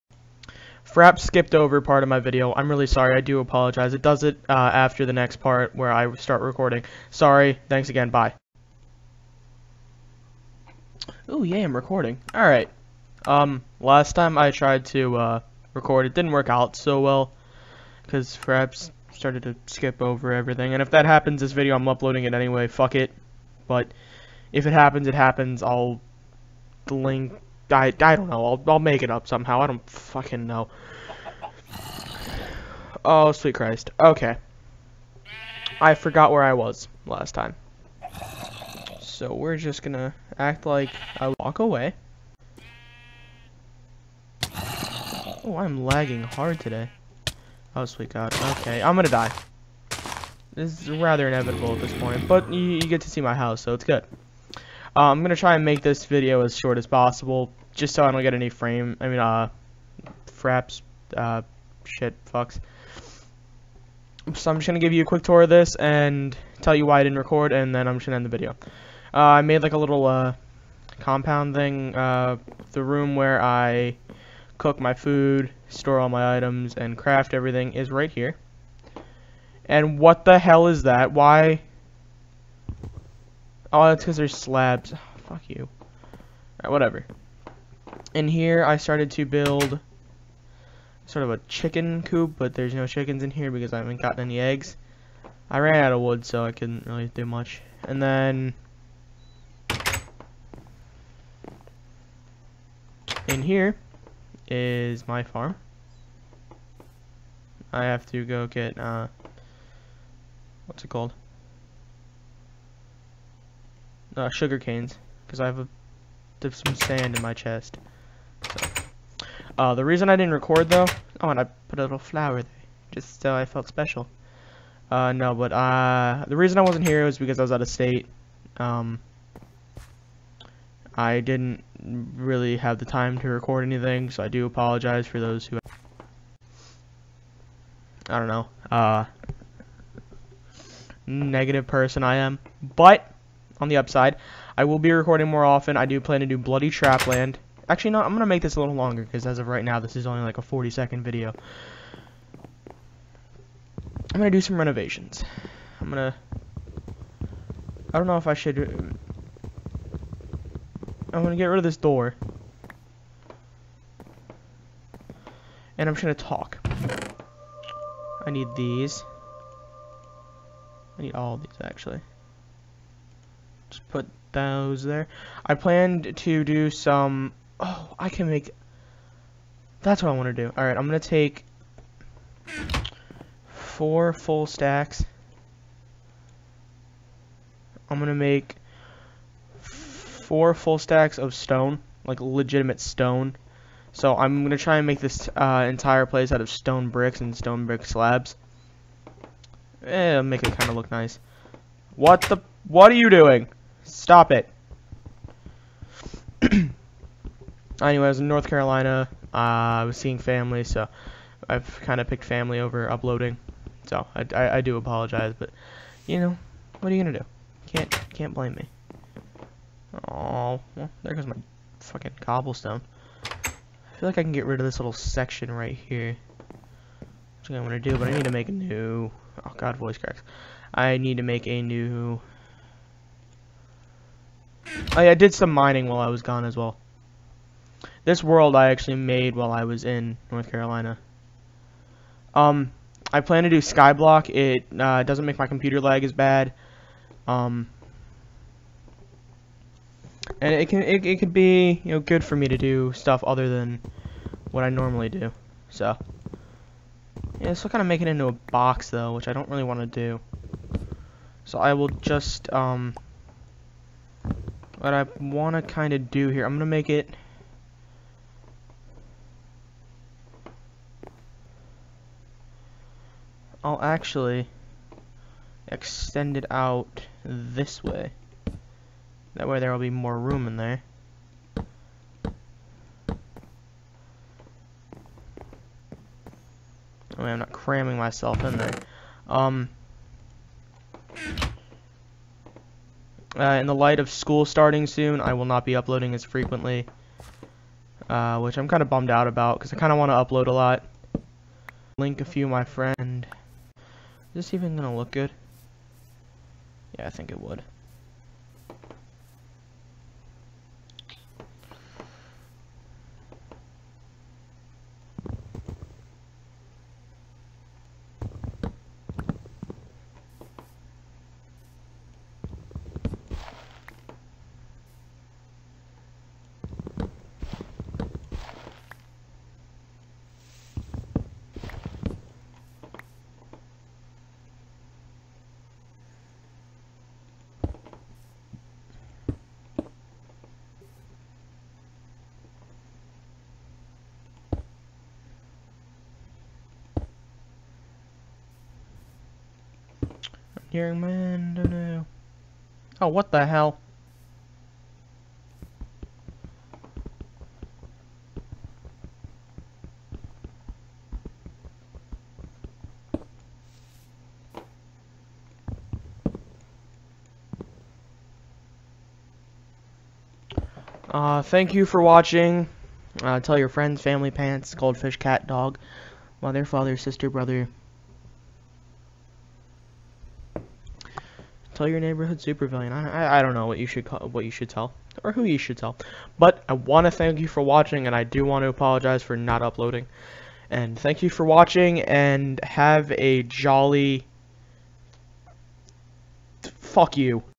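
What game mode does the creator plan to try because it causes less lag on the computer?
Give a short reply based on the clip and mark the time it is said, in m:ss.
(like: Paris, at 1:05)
Skyblock, at 4:03.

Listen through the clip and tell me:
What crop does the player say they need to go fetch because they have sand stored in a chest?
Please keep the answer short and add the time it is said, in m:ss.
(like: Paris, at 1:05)
Sugar canes, at 1:54.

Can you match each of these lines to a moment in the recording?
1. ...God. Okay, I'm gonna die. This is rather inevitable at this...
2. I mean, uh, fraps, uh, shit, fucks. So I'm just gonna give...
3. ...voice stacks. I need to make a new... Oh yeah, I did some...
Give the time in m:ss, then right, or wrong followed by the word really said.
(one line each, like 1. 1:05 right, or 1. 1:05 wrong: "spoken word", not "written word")
1. 0:48 right
2. 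0:58 right
3. 3:49 wrong: "cracks", not "stacks".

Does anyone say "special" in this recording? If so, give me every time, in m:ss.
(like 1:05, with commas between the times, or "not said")
2:03.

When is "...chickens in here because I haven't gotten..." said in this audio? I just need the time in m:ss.
1:32.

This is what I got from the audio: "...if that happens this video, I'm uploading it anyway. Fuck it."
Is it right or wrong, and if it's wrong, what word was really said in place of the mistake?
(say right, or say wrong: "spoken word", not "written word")
right.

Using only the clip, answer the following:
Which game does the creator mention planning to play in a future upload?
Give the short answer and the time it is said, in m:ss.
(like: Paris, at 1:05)
Bloody Trapland, at 2:26.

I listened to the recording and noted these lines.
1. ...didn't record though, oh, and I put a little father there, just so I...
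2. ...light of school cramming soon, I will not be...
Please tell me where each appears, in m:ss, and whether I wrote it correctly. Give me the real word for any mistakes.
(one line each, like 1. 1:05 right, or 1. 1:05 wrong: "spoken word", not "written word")
1. 2:00 wrong: "flower", not "father"
2. 4:53 wrong: "starting", not "cramming".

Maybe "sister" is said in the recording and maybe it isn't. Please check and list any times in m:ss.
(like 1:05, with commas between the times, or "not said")
6:16.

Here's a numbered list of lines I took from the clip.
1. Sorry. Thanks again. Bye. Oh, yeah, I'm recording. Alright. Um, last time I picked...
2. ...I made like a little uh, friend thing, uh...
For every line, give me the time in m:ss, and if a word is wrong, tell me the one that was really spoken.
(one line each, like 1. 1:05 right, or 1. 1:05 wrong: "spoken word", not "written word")
1. 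0:07 wrong: "tried", not "picked"
2. 1:09 wrong: "compound", not "friend".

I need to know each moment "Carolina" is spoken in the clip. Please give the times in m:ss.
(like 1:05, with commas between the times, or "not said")
3:28, 4:00.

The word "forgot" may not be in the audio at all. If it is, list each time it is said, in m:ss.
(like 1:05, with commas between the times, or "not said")
0:35.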